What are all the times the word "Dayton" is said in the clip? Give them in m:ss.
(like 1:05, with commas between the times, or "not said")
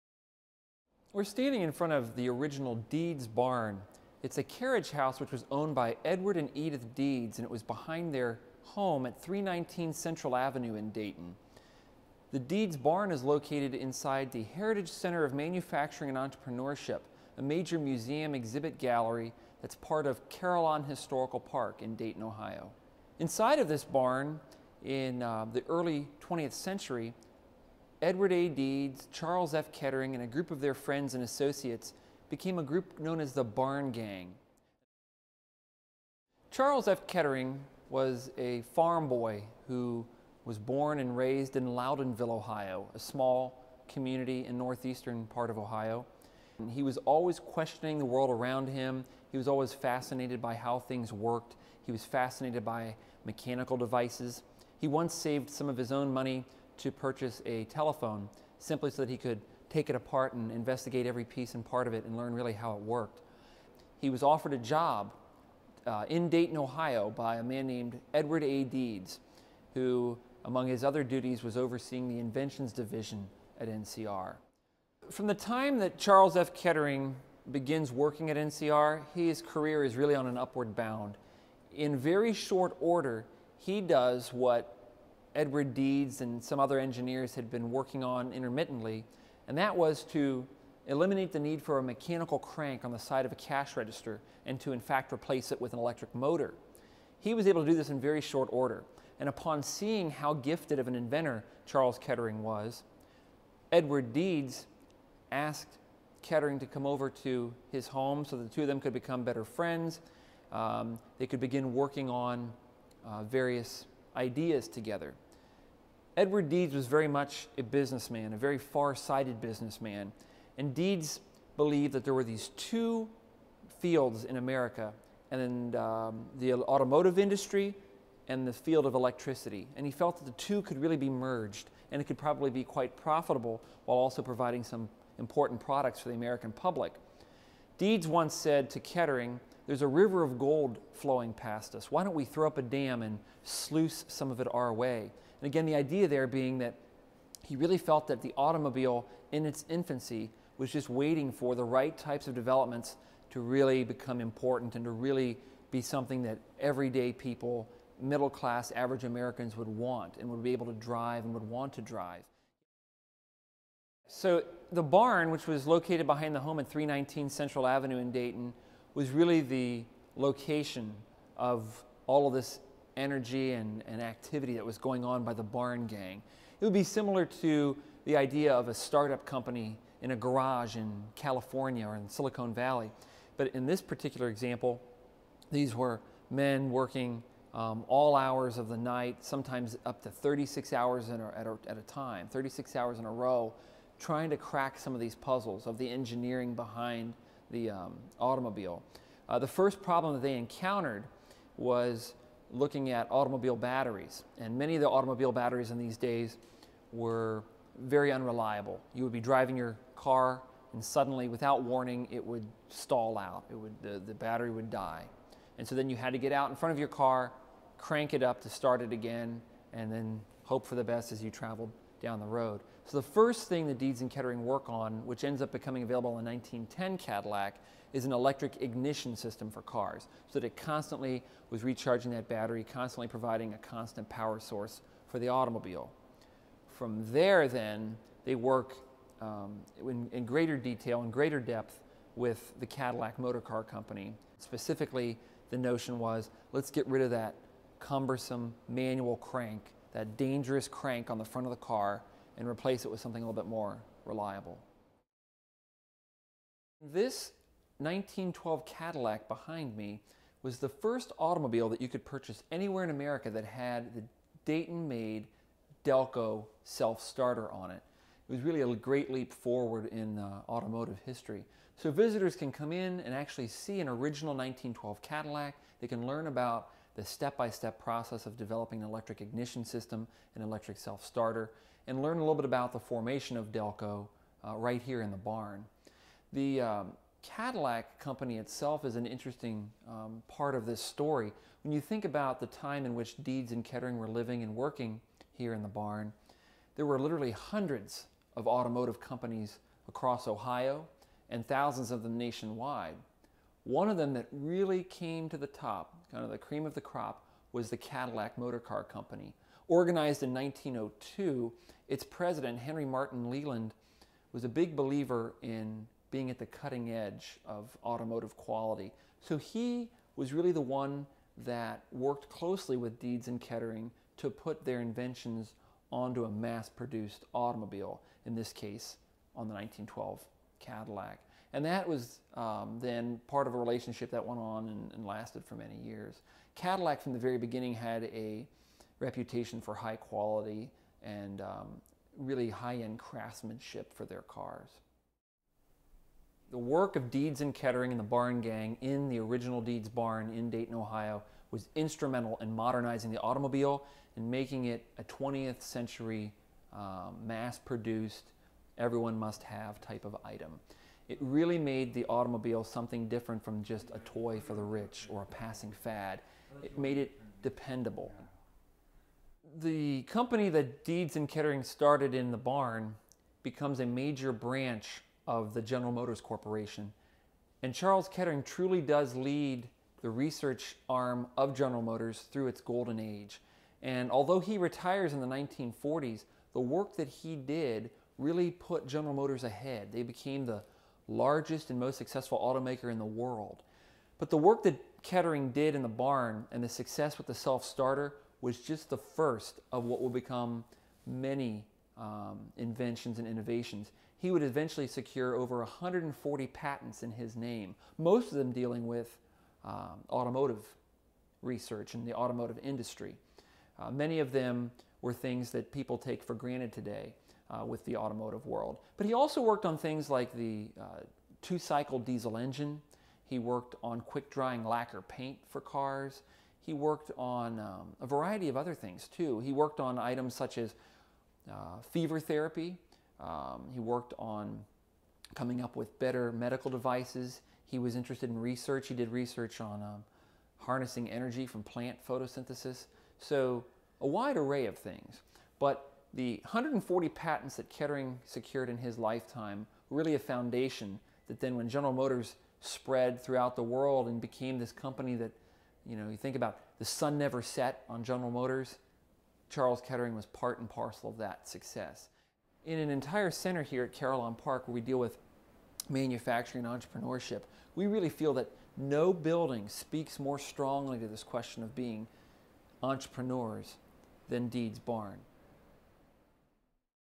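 0:10, 0:21, 1:06, 2:48, 4:24, 5:50.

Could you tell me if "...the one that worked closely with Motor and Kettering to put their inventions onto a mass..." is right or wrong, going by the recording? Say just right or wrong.
wrong.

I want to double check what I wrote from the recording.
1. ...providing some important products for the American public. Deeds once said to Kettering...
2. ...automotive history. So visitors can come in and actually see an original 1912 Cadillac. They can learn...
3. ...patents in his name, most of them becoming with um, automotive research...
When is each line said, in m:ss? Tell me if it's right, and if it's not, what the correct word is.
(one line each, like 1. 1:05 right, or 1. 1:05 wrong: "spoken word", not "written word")
1. 2:14 right
2. 4:30 right
3. 6:46 wrong: "dealing", not "becoming".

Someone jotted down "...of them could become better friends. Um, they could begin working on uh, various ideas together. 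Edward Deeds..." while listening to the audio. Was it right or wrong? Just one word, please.
right.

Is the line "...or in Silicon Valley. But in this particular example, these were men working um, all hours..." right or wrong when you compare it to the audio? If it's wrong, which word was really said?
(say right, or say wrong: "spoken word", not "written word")
right.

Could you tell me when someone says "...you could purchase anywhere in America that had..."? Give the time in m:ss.
4:21.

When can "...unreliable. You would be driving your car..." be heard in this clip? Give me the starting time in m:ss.
3:28.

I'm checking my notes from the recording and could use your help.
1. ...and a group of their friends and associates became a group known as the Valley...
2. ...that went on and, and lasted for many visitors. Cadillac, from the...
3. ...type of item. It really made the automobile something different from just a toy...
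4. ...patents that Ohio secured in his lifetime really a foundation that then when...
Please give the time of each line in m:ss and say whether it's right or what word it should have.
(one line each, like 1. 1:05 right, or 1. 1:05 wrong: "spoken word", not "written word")
1. 0:30 wrong: "Barn", not "Valley"
2. 5:34 wrong: "years", not "visitors"
3. 5:59 right
4. 7:27 wrong: "Kettering", not "Ohio".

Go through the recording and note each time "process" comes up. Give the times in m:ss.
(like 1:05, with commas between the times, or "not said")
4:37.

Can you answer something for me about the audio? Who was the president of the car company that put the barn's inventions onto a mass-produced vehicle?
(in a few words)
Henry Martin Leland.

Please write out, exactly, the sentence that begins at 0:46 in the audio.
And he was always questioning the world around him.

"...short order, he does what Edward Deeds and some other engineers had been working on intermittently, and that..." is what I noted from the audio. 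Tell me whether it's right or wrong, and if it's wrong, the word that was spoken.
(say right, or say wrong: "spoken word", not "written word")
right.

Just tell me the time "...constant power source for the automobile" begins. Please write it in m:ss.
3:53.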